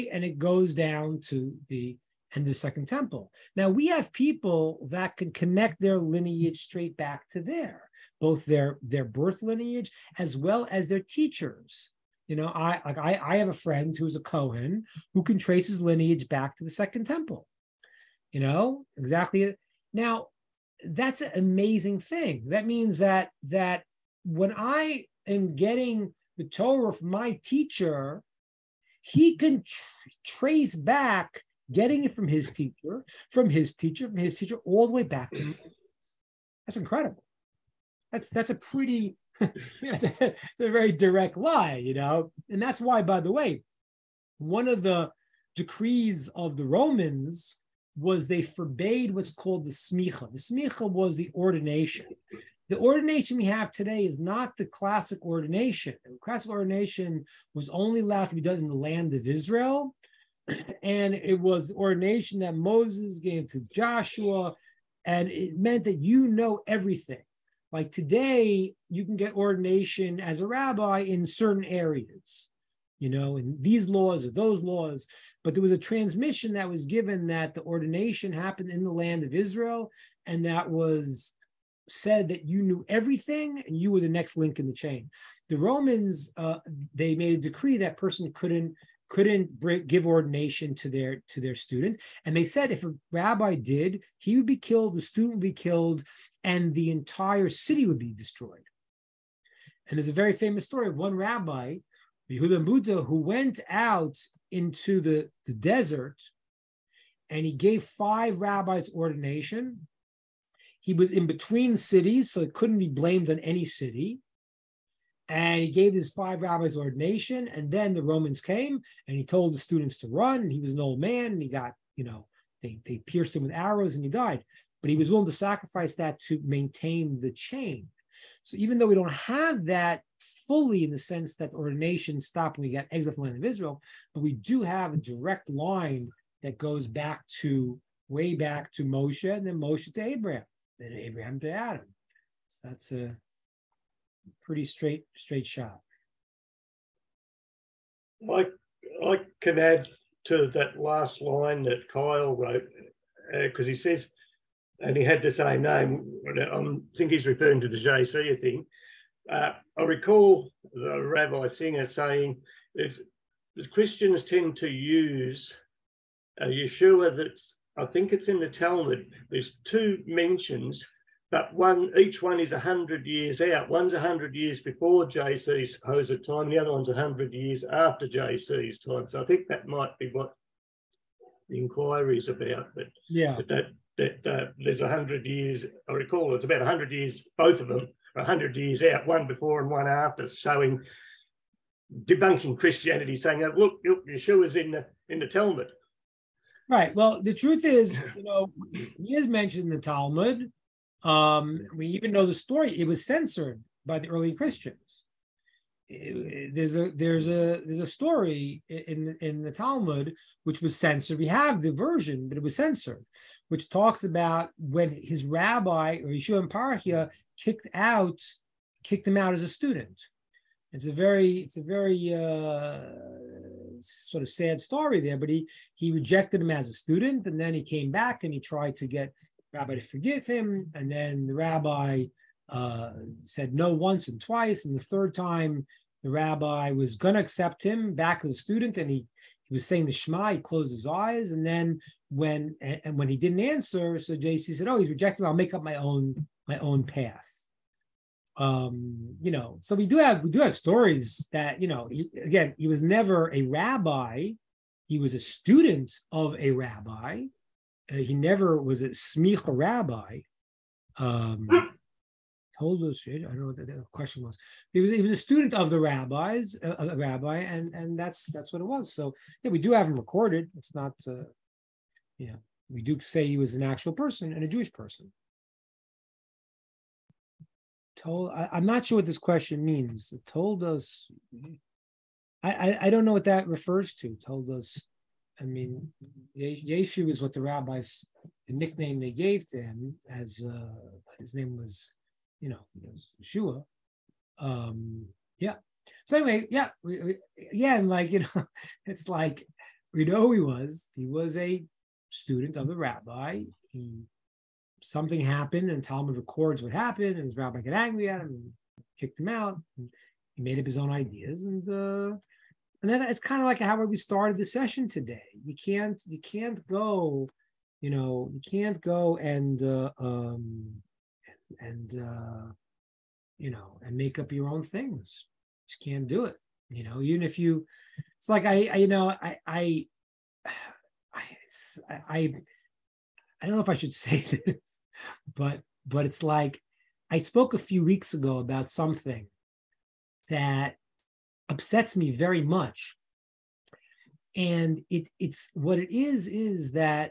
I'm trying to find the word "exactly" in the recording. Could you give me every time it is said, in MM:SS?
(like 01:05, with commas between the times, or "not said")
00:18.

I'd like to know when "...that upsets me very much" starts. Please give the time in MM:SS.
05:40.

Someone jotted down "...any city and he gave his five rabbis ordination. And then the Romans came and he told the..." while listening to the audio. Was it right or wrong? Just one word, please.
right.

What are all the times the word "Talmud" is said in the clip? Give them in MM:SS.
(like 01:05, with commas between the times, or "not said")
02:48, 03:15, 03:19, 03:29, 05:05.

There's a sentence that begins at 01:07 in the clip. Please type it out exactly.
Like today, you can get ordination as a rabbi in certain areas, you know, in these laws or those laws.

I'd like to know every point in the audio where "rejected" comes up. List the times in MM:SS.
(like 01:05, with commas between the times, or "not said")
03:45, 04:04.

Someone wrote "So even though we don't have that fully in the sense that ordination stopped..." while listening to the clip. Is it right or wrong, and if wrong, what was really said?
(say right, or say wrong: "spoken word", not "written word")
right.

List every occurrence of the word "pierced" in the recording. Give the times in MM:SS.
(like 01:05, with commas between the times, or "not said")
02:03.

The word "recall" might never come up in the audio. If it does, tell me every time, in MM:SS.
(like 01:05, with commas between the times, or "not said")
02:39, 03:05.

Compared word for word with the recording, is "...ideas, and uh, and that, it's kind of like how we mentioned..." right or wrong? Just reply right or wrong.
wrong.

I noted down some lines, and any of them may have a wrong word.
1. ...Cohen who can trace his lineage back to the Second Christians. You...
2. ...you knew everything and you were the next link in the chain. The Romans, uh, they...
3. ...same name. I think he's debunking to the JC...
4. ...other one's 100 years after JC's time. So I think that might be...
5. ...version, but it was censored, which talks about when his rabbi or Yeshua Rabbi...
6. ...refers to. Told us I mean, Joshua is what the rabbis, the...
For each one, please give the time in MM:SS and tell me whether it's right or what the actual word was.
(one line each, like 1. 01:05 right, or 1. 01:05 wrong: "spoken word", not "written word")
1. 00:14 wrong: "Temple", not "Christians"
2. 01:22 right
3. 02:35 wrong: "referring", not "debunking"
4. 02:56 right
5. 03:31 wrong: "Parhia", not "Rabbi"
6. 04:43 wrong: "Yeshu", not "Joshua".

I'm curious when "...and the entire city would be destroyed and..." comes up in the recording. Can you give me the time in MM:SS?
01:36.